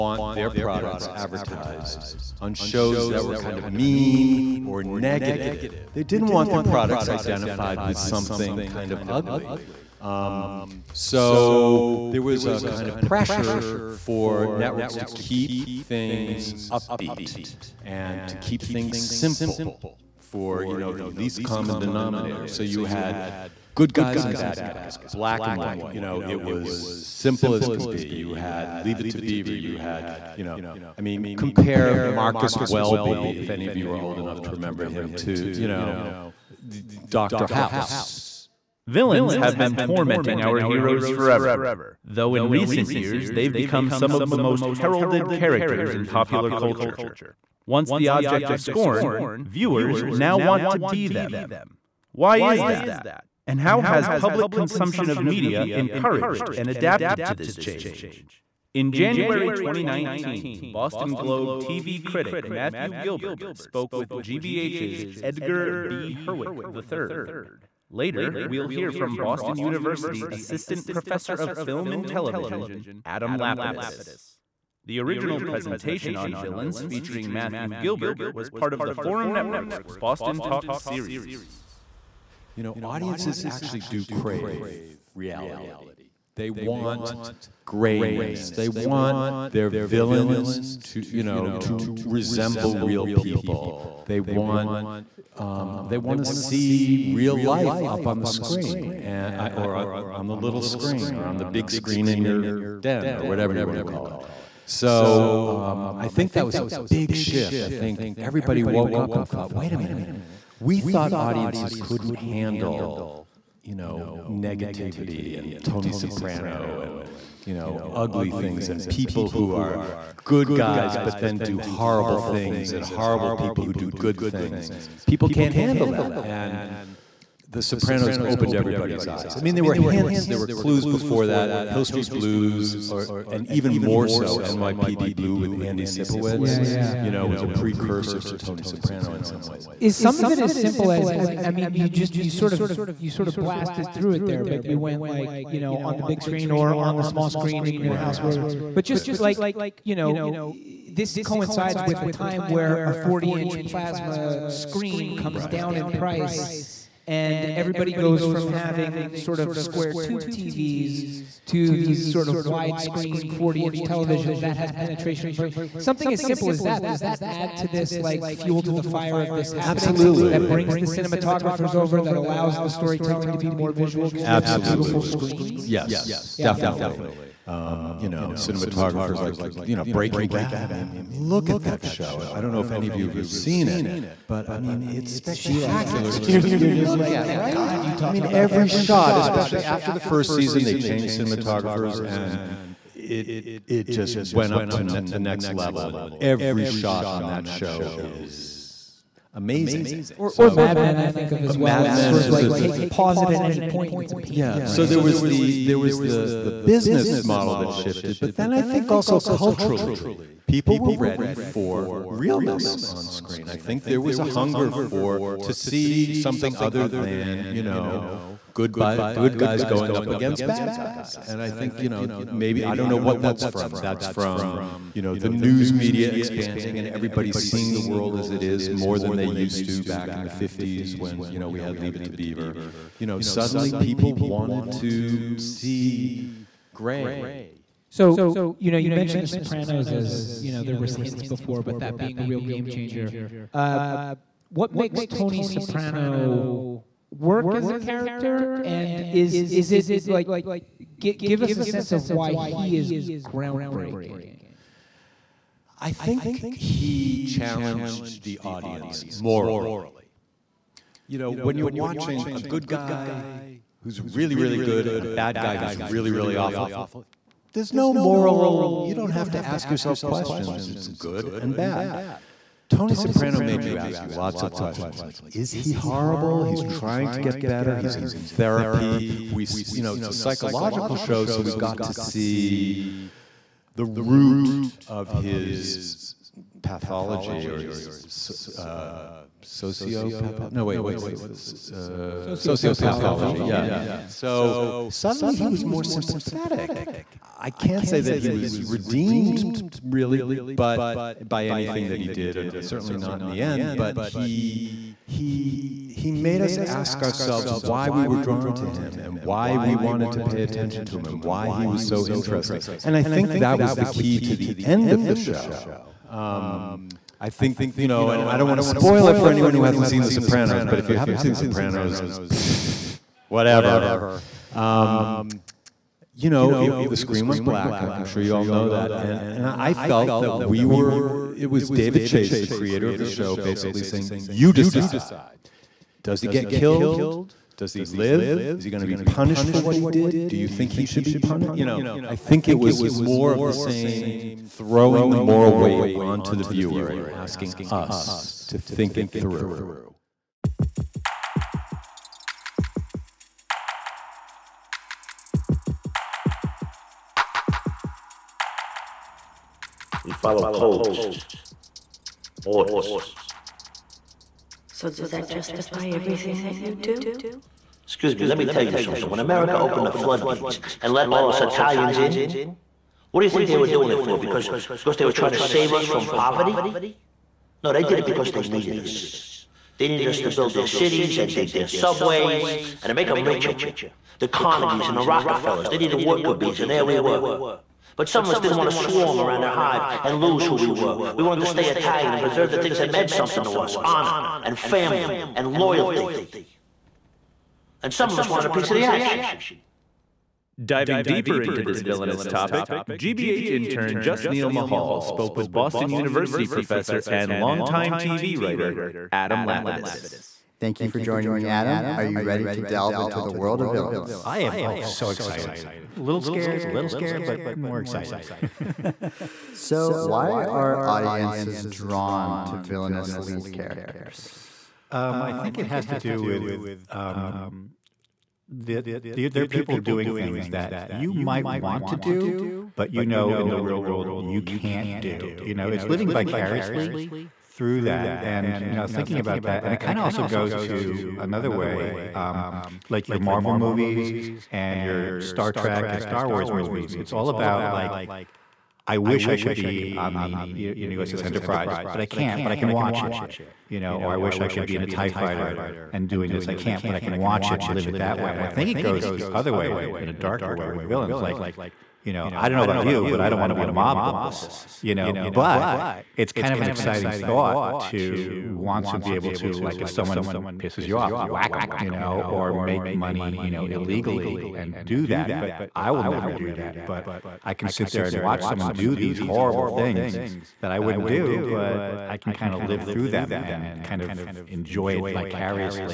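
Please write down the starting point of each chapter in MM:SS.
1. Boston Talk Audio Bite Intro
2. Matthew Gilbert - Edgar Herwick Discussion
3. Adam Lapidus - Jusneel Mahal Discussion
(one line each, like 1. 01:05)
1. 00:38
2. 01:21
3. 06:40.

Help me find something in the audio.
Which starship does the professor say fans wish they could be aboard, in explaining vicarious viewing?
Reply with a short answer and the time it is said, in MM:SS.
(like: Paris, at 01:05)
USS Enterprise, at 07:31.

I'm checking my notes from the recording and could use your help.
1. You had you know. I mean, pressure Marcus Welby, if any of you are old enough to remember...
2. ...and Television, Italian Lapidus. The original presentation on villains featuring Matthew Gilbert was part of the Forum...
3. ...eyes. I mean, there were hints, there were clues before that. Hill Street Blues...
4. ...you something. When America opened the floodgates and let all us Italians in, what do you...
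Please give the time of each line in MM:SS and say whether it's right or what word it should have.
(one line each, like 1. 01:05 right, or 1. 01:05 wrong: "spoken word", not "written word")
1. 00:29 wrong: "compare", not "pressure"
2. 01:11 wrong: "Adam", not "Italian"
3. 02:09 right
4. 06:08 right.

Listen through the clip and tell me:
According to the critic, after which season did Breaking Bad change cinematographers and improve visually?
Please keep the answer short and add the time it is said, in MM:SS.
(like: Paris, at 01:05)
the first season, at 03:09.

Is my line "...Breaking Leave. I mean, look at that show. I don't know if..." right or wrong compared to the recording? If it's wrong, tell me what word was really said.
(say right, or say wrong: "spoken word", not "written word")
wrong: "Bad", not "Leave".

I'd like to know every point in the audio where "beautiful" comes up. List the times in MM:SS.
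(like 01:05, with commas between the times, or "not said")
02:54.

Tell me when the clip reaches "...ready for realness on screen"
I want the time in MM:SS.
03:30.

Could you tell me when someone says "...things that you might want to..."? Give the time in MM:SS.
07:10.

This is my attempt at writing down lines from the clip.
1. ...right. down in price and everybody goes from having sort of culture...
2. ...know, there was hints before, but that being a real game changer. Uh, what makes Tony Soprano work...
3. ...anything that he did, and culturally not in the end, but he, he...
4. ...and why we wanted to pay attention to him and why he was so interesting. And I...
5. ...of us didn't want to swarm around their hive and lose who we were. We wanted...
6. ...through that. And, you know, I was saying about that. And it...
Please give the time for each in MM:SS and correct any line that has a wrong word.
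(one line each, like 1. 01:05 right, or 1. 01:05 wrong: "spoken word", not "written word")
1. 02:35 wrong: "square", not "culture"
2. 04:00 right
3. 05:01 wrong: "certainly", not "culturally"
4. 05:09 right
5. 06:28 right
6. 07:17 wrong: "thinking", not "saying".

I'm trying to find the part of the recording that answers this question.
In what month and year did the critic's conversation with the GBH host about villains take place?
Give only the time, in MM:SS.
00:58.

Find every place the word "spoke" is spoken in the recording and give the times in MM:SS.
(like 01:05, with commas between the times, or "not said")
01:03, 06:45.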